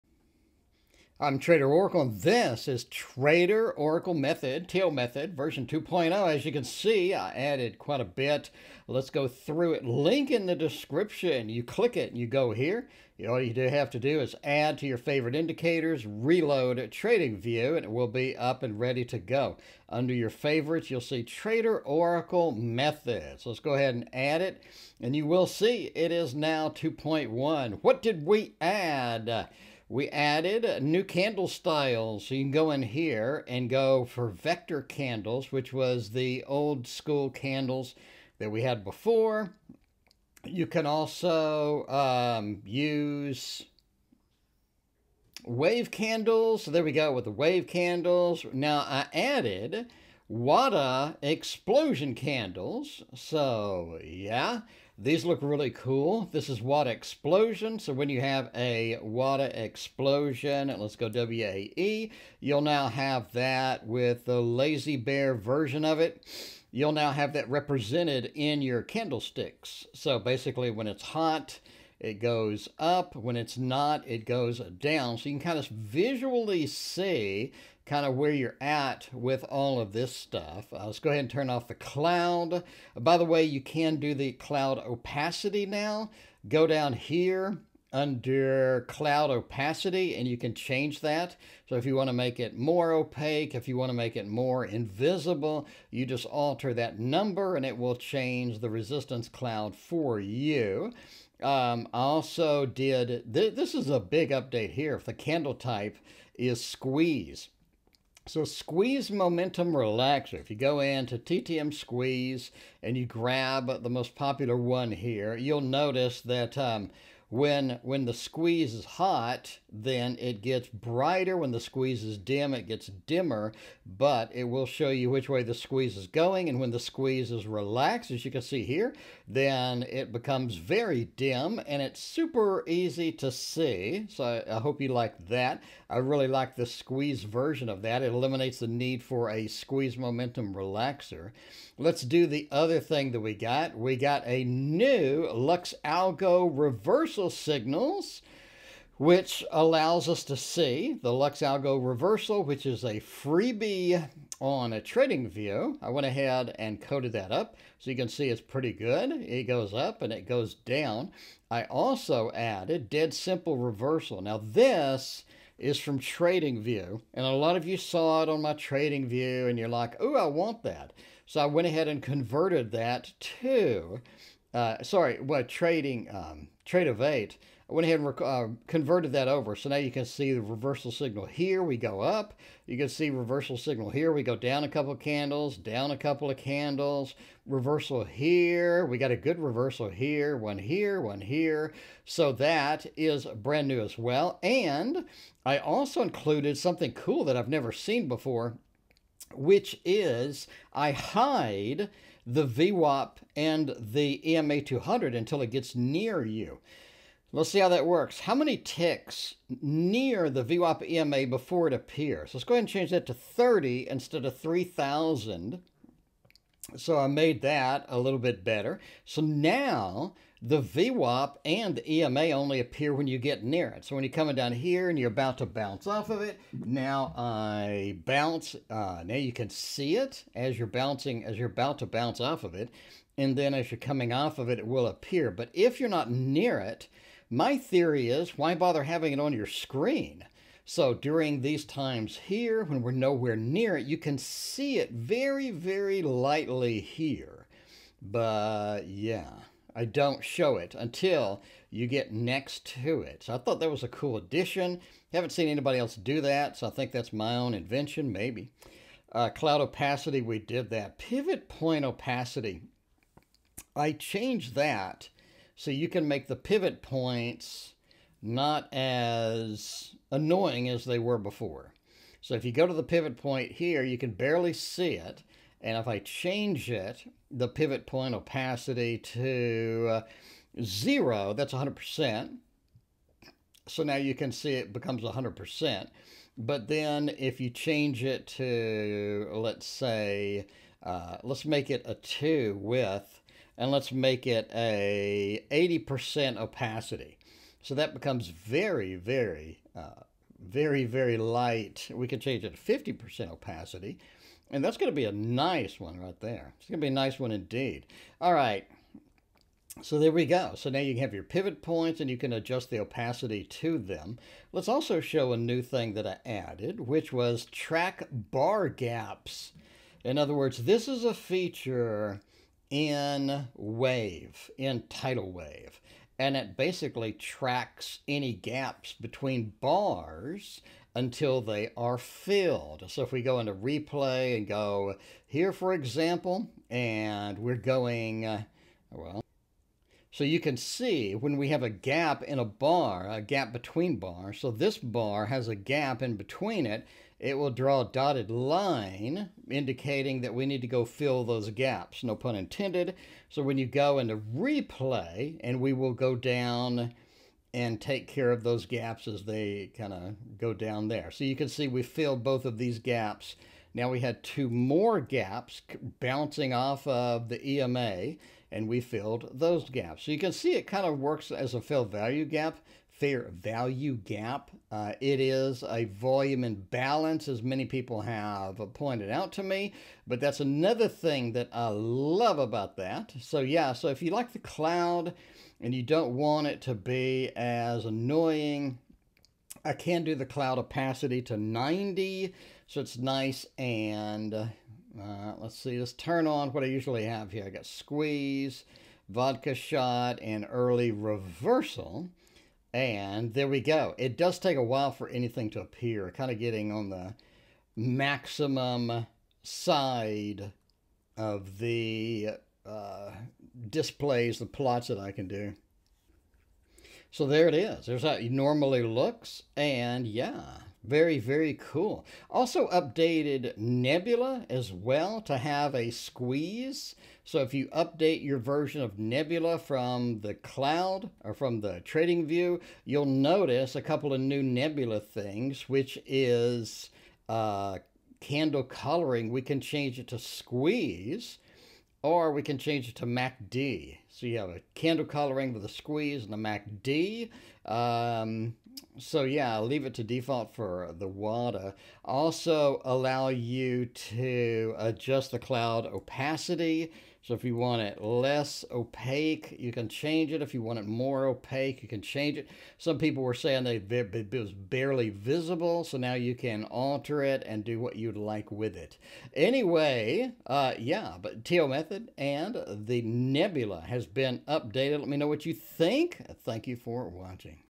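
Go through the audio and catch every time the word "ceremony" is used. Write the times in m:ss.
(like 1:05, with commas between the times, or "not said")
not said.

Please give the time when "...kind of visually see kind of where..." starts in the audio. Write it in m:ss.
1:15.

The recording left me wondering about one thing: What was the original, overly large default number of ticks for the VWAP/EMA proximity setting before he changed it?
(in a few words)
3,000.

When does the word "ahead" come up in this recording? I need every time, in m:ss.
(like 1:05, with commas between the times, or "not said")
0:23, 1:21, 2:36, 2:51, 2:57, 3:32.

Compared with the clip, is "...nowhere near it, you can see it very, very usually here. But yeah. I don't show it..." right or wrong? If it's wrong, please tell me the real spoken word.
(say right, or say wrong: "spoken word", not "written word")
wrong: "lightly", not "usually".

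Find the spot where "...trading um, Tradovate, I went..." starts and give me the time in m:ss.
2:55.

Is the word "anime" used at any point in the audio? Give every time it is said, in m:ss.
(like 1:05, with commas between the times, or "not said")
not said.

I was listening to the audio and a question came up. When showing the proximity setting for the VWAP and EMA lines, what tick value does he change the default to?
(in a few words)
30.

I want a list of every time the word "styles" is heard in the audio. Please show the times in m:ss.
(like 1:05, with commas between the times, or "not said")
0:31.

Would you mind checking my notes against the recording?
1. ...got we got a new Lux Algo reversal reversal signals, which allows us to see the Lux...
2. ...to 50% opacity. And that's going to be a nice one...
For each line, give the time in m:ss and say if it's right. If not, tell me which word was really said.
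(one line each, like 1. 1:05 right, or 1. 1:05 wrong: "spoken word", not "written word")
1. 2:23 right
2. 5:02 right.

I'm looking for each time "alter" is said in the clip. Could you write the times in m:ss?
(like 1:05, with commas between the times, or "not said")
1:36, 7:46.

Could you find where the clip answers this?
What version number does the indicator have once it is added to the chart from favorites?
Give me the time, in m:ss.
0:26.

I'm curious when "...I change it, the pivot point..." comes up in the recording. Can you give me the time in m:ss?
4:35.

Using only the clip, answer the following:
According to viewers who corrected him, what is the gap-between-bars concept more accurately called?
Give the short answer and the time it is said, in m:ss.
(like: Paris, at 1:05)
Volume imbalance, at 6:15.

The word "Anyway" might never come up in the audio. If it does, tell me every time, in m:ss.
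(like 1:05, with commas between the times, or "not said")
7:49.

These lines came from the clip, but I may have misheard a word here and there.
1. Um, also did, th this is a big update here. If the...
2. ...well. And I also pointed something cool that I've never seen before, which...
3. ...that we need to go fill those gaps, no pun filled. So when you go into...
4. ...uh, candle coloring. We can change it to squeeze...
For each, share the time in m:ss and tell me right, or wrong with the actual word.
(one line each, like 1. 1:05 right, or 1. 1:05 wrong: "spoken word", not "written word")
1. 1:41 right
2. 3:13 wrong: "included", not "pointed"
3. 5:50 wrong: "intended", not "filled"
4. 7:17 right.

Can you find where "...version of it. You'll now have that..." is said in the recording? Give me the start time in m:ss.
1:05.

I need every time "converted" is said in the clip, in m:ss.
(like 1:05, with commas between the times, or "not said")
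2:52, 2:58.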